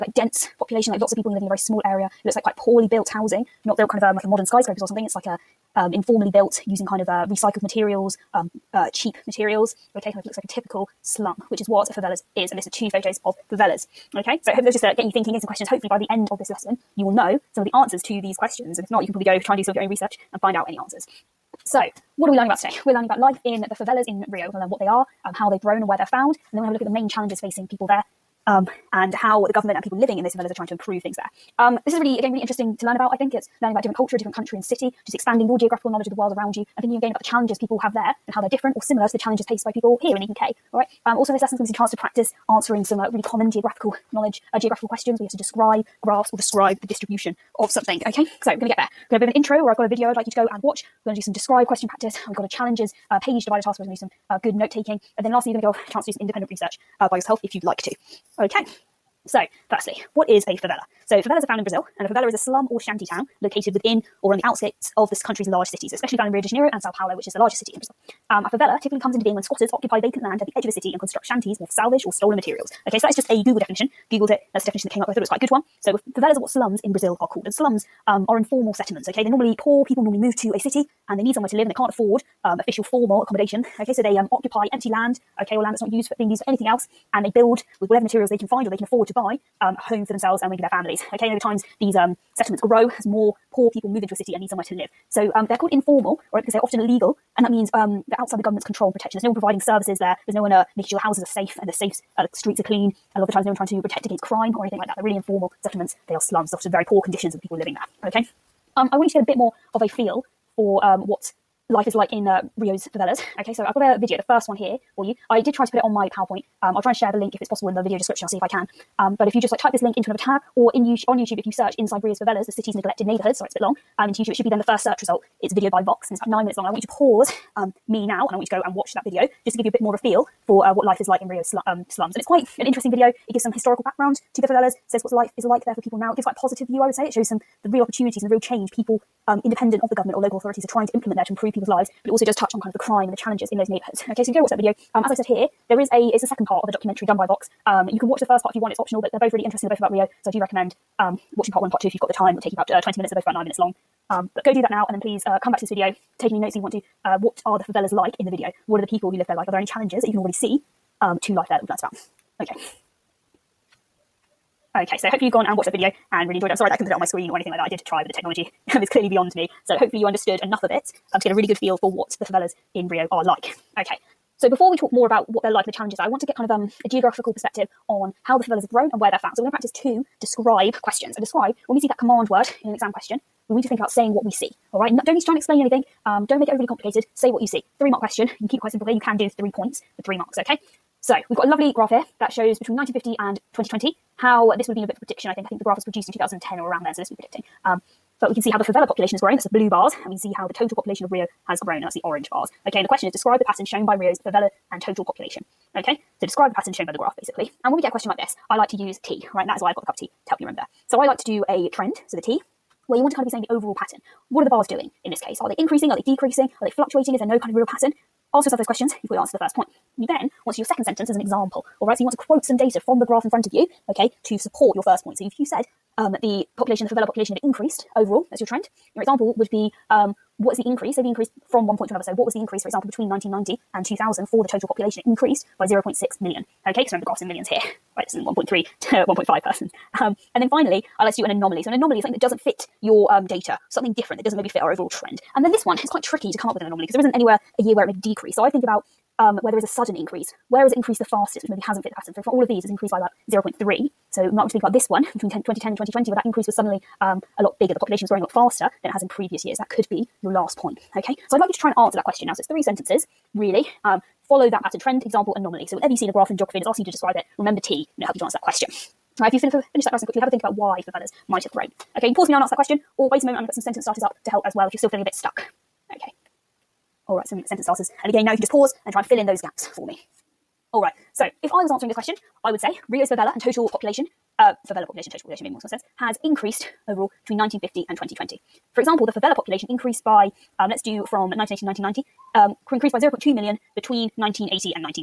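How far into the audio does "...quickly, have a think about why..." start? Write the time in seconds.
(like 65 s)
270 s.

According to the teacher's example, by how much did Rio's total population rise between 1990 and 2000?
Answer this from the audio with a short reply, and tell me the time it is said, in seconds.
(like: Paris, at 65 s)
0.6 million, at 235 s.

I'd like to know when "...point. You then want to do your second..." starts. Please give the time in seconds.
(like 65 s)
219 s.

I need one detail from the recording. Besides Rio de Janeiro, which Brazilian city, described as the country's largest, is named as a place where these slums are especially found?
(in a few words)
Sao Paulo.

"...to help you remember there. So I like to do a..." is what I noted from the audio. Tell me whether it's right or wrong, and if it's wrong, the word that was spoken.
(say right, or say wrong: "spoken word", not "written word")
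right.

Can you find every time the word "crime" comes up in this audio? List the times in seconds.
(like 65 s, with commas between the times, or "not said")
104 s, 142 s.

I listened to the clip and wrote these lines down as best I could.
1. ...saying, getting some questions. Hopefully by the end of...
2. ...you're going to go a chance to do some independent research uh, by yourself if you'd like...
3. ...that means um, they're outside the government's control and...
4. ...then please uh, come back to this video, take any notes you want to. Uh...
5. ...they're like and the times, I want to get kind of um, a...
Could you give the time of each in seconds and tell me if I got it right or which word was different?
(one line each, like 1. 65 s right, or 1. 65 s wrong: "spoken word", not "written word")
1. 15 s wrong: "thinking", not "saying"
2. 55 s right
3. 97 s right
4. 154 s right
5. 175 s wrong: "challenges", not "times".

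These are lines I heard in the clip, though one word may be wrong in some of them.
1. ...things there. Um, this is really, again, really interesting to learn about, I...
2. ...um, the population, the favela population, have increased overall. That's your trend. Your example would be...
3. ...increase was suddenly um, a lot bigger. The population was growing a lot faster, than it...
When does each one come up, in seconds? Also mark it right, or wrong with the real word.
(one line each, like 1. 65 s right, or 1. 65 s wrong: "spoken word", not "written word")
1. 31 s right
2. 225 s right
3. 256 s right.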